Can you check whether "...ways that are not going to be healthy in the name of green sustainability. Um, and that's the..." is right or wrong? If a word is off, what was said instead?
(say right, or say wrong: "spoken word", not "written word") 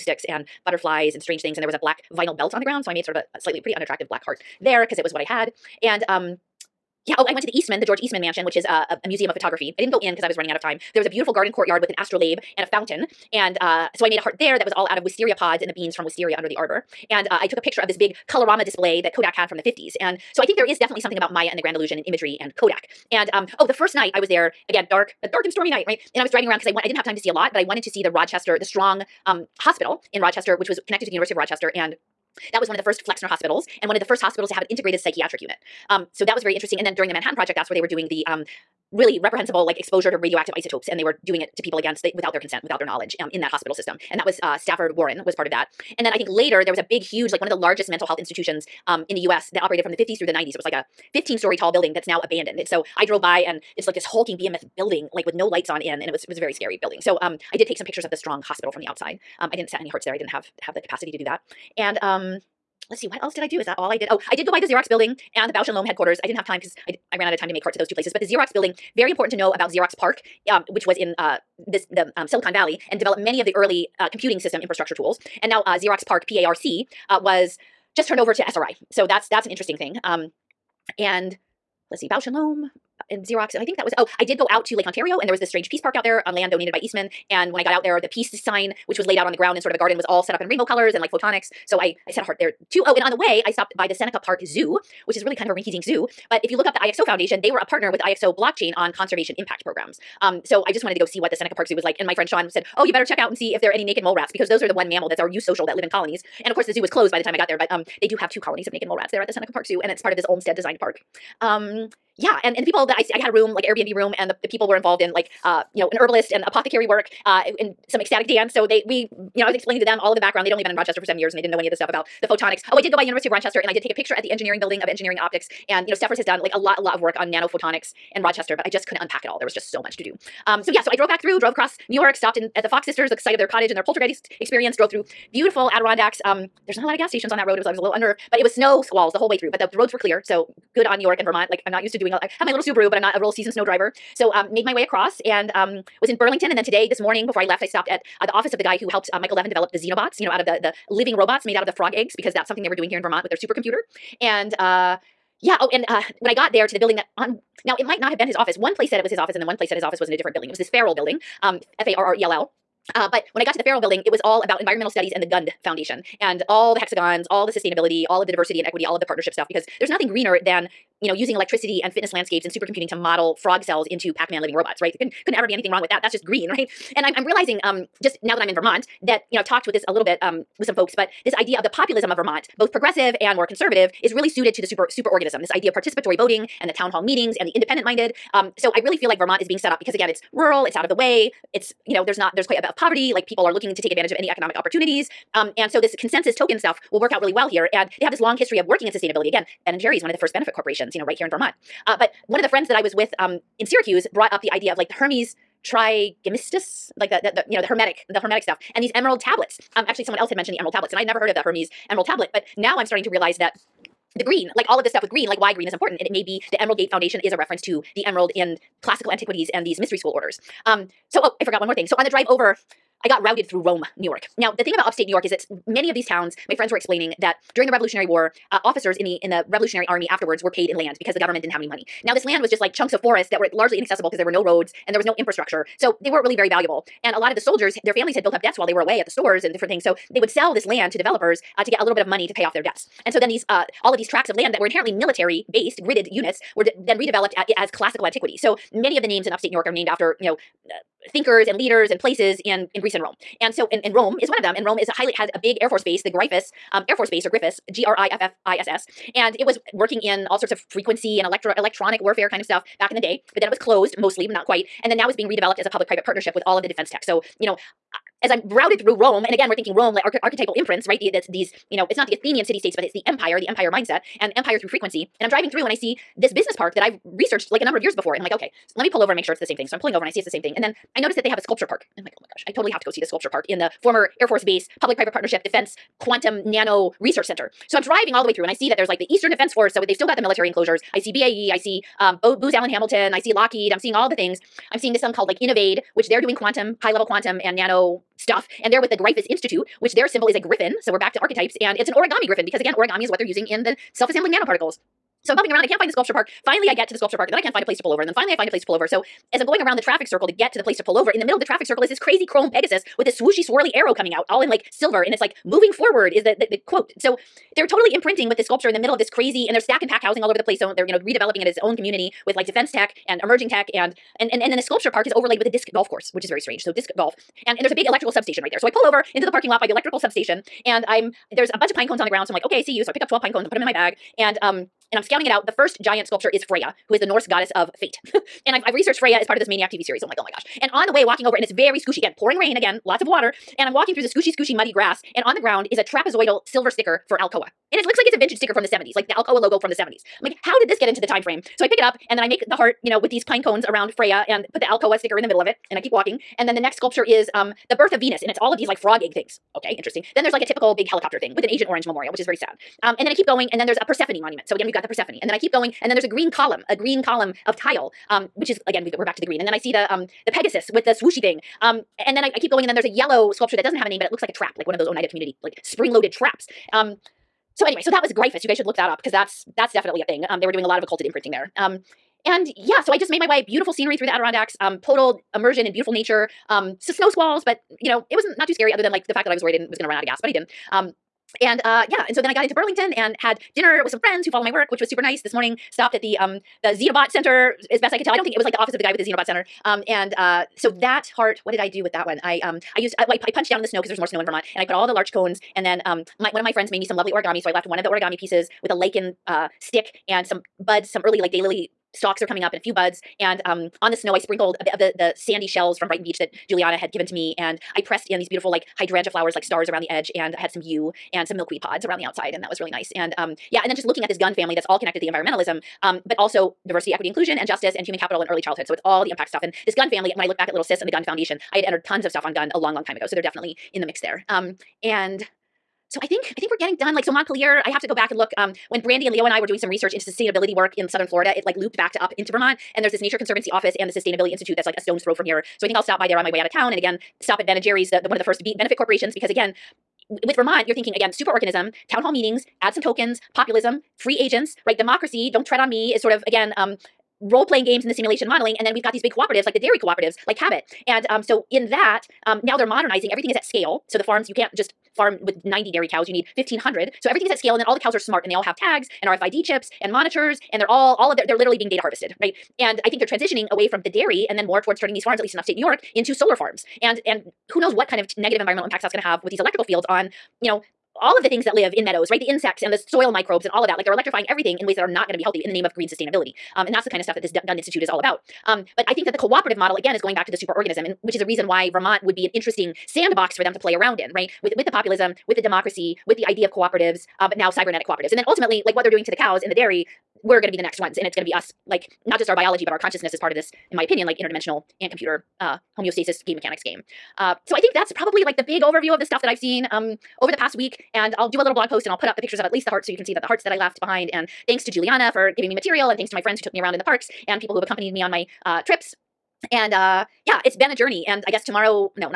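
right.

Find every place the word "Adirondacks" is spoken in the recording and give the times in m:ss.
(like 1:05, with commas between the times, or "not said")
2:15, 6:24.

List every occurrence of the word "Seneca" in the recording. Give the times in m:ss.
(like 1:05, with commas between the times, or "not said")
1:33, 1:41, 1:49.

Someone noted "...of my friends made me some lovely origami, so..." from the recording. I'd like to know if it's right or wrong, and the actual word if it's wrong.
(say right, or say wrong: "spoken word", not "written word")
right.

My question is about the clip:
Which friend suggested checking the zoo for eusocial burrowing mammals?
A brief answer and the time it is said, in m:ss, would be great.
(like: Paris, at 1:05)
Sean, at 1:42.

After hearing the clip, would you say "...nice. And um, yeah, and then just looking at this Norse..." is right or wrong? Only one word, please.
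wrong.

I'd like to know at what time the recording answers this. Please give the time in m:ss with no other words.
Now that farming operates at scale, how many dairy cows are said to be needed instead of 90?
7:46.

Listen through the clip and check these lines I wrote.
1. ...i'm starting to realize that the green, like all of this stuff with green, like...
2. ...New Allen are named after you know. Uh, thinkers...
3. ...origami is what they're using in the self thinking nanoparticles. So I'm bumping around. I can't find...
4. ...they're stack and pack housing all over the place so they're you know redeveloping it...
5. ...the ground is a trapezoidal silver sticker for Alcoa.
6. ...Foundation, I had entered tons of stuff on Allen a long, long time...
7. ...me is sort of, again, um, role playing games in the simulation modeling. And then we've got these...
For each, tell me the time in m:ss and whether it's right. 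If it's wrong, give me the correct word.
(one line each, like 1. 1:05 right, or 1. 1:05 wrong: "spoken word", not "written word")
1. 3:32 right
2. 4:09 wrong: "York", not "Allen"
3. 5:02 wrong: "assembling", not "thinking"
4. 5:19 right
5. 5:45 right
6. 7:11 wrong: "Gund", not "Allen"
7. 7:35 right.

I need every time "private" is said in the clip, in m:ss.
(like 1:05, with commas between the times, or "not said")
4:25, 4:44.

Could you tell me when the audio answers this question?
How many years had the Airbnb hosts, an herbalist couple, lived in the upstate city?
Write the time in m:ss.
2:01.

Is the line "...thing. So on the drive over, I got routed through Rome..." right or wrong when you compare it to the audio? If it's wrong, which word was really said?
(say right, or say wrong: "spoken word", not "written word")
right.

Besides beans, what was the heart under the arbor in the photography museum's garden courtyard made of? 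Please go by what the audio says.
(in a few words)
wisteria pods.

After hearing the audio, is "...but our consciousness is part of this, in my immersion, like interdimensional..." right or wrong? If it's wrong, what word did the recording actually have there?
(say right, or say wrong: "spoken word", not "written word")
wrong: "opinion", not "immersion".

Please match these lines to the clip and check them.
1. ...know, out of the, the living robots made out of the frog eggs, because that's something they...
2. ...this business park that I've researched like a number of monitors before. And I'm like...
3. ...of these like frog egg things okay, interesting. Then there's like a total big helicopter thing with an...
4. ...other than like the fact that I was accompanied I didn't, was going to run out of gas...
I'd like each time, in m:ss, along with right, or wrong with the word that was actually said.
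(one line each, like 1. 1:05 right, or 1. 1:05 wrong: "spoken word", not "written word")
1. 2:30 right
2. 4:36 wrong: "years", not "monitors"
3. 5:58 wrong: "typical", not "total"
4. 6:28 wrong: "worried", not "accompanied".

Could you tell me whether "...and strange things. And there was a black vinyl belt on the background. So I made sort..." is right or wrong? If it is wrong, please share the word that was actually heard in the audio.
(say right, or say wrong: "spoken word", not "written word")
wrong: "ground", not "background".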